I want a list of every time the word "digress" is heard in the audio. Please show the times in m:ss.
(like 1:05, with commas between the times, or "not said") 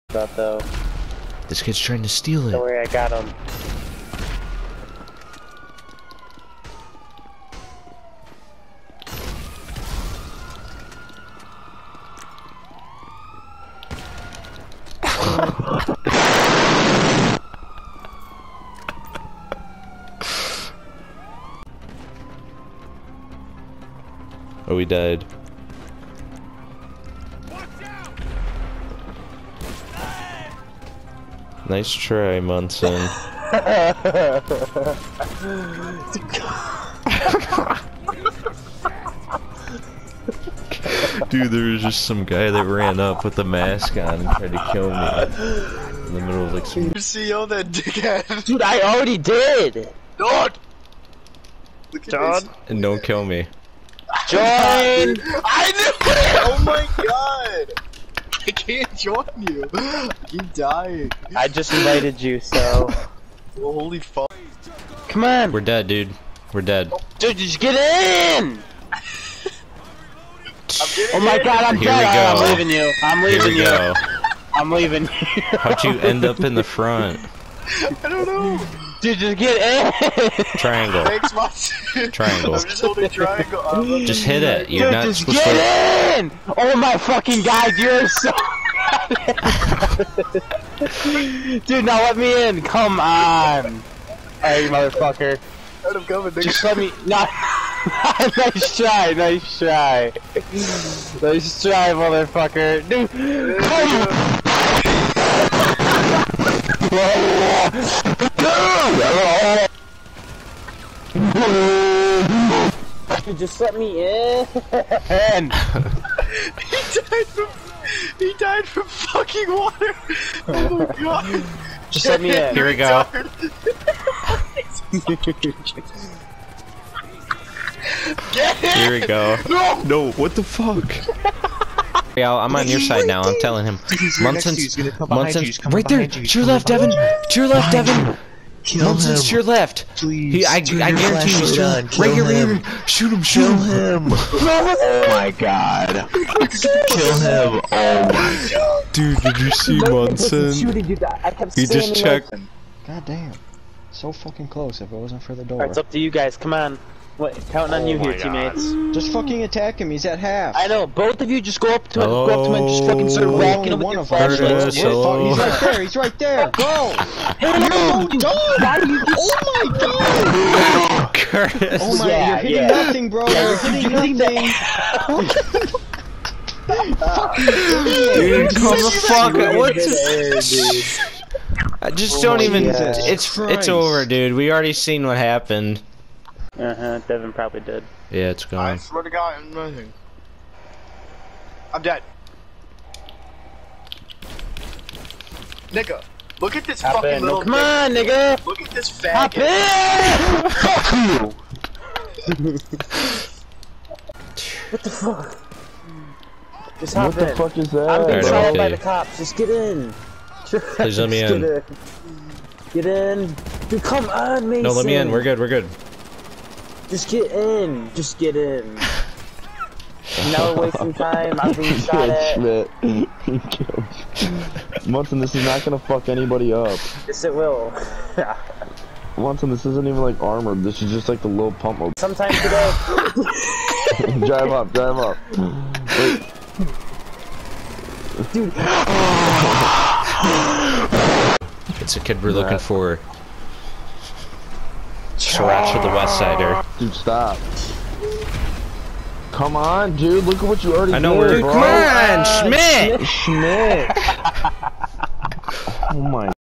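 not said.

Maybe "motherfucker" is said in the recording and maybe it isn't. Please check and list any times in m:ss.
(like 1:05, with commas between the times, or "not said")
1:34, 1:41.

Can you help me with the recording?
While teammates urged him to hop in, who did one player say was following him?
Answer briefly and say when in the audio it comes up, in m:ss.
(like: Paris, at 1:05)
the cops, at 3:28.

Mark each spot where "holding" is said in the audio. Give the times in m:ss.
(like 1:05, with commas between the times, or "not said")
1:22.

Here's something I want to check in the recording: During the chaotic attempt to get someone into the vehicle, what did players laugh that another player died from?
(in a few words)
water.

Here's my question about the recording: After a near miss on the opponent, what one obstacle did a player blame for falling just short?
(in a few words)
the door.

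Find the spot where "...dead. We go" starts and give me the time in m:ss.
1:11.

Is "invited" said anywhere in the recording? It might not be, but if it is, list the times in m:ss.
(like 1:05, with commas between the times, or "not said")
1:01.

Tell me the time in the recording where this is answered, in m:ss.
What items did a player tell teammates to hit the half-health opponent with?
2:44.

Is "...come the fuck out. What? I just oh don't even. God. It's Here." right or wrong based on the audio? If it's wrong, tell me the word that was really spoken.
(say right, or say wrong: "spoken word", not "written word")
wrong: "Christ", not "Here".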